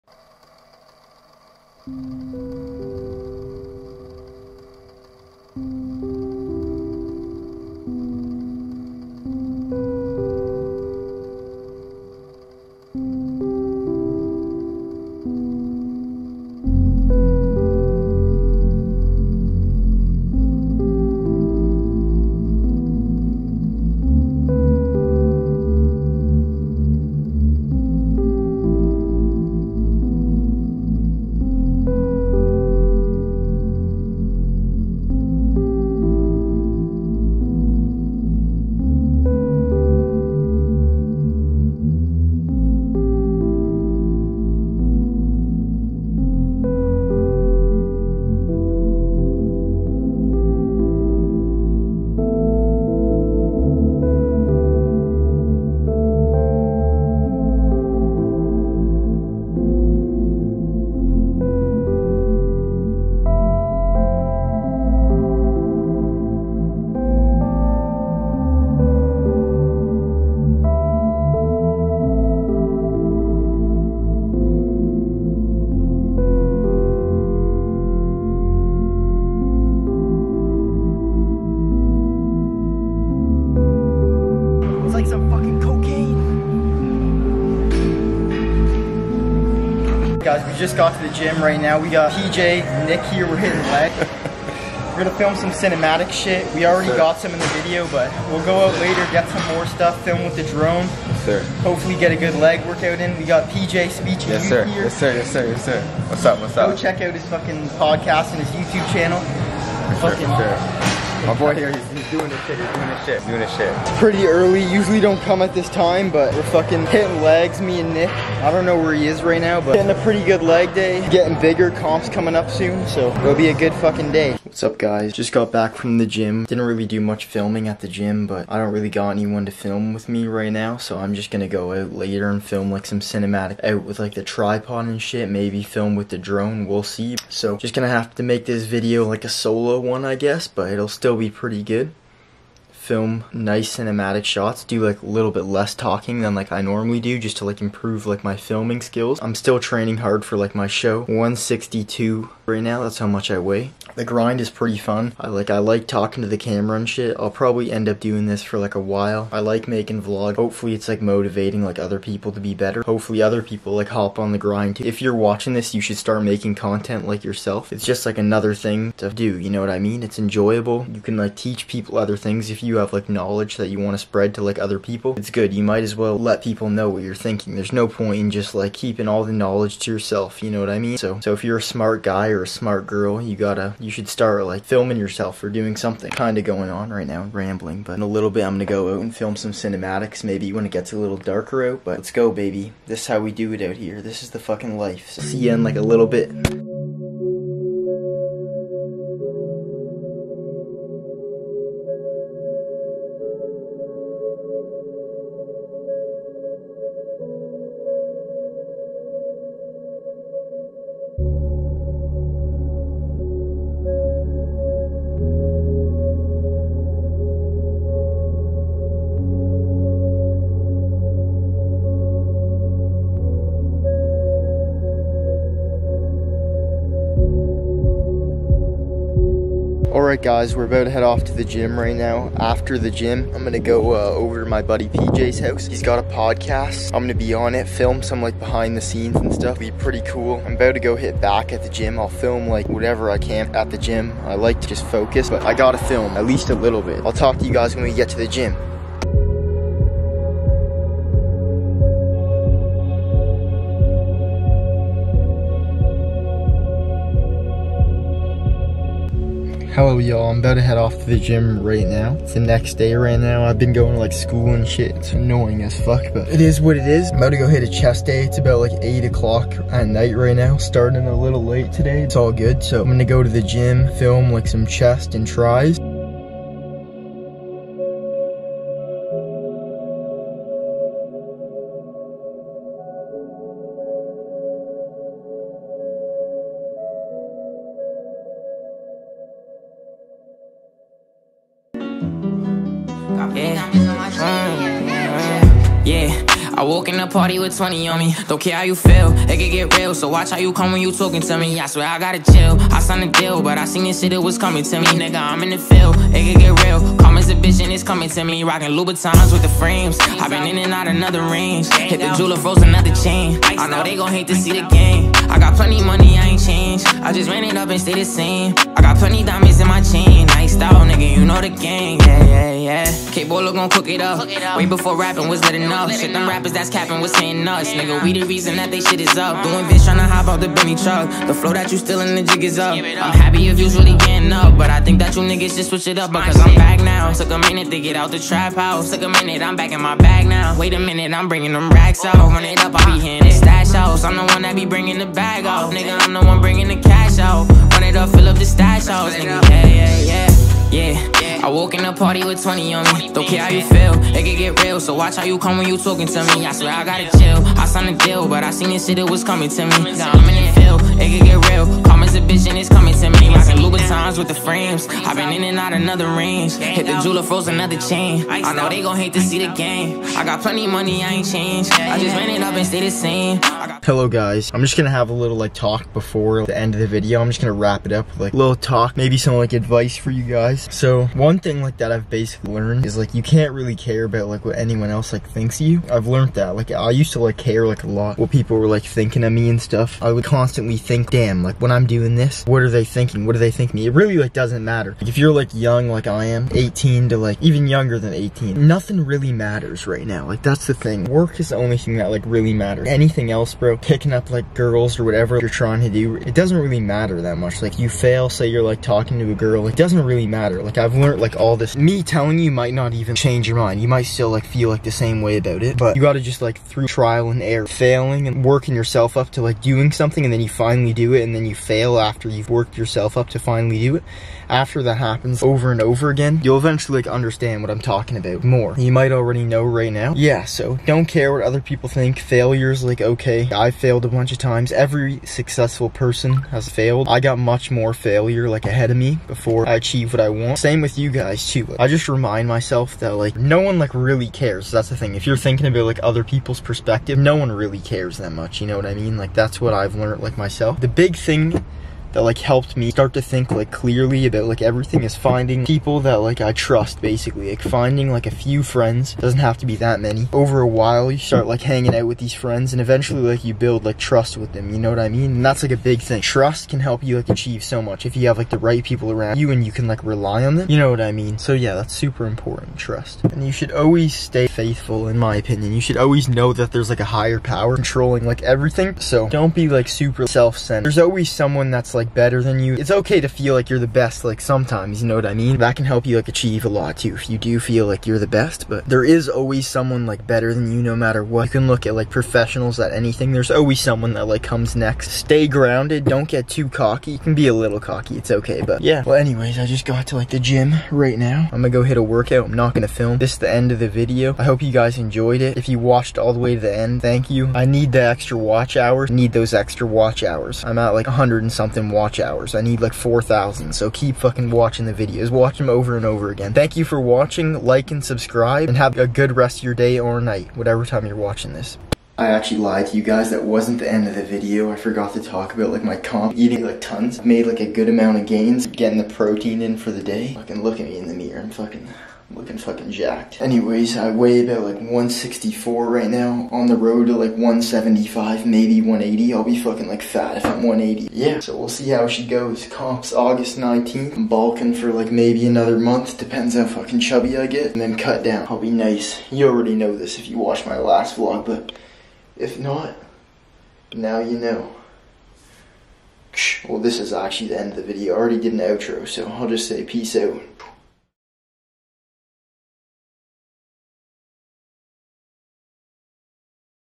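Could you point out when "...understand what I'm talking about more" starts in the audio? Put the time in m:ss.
7:07.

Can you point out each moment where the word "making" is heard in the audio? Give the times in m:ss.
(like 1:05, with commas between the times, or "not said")
2:39, 2:46.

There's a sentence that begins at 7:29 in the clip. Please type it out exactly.
Like that's what I've learned like myself.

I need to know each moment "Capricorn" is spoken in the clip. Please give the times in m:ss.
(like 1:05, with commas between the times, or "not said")
not said.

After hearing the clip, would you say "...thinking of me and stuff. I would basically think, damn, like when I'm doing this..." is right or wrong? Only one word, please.
wrong.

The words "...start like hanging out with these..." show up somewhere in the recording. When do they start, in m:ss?
7:41.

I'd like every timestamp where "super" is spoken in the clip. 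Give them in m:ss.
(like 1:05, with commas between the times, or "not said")
7:51, 7:59.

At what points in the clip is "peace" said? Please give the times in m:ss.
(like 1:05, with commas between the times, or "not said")
9:19.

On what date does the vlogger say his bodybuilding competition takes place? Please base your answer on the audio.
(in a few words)
August 19th.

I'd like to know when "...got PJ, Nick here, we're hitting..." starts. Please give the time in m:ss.
1:31.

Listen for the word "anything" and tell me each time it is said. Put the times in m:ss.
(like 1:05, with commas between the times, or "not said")
6:42, 8:12.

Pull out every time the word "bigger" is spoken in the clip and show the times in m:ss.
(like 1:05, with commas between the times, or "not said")
2:01.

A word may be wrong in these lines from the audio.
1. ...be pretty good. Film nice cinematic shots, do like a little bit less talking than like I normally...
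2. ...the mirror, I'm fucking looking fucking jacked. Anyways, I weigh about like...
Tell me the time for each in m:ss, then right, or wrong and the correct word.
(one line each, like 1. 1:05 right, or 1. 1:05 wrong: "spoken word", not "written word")
1. 2:21 right
2. 8:51 right.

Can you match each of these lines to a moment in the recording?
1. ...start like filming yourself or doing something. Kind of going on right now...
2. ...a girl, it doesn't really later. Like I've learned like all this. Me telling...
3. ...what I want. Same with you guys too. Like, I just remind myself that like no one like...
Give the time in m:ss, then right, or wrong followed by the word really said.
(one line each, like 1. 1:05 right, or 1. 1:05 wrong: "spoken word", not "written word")
1. 3:04 right
2. 6:49 wrong: "matter", not "later"
3. 7:20 right.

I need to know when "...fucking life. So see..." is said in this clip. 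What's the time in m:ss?
3:14.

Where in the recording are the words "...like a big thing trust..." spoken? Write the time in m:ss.
7:45.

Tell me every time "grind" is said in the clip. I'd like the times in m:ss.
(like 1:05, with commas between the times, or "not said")
2:34, 2:44.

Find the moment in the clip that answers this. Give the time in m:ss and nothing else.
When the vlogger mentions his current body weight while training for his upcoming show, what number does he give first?
2:31.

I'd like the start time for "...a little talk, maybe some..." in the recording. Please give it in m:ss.
6:18.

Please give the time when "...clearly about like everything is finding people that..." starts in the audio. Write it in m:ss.
7:33.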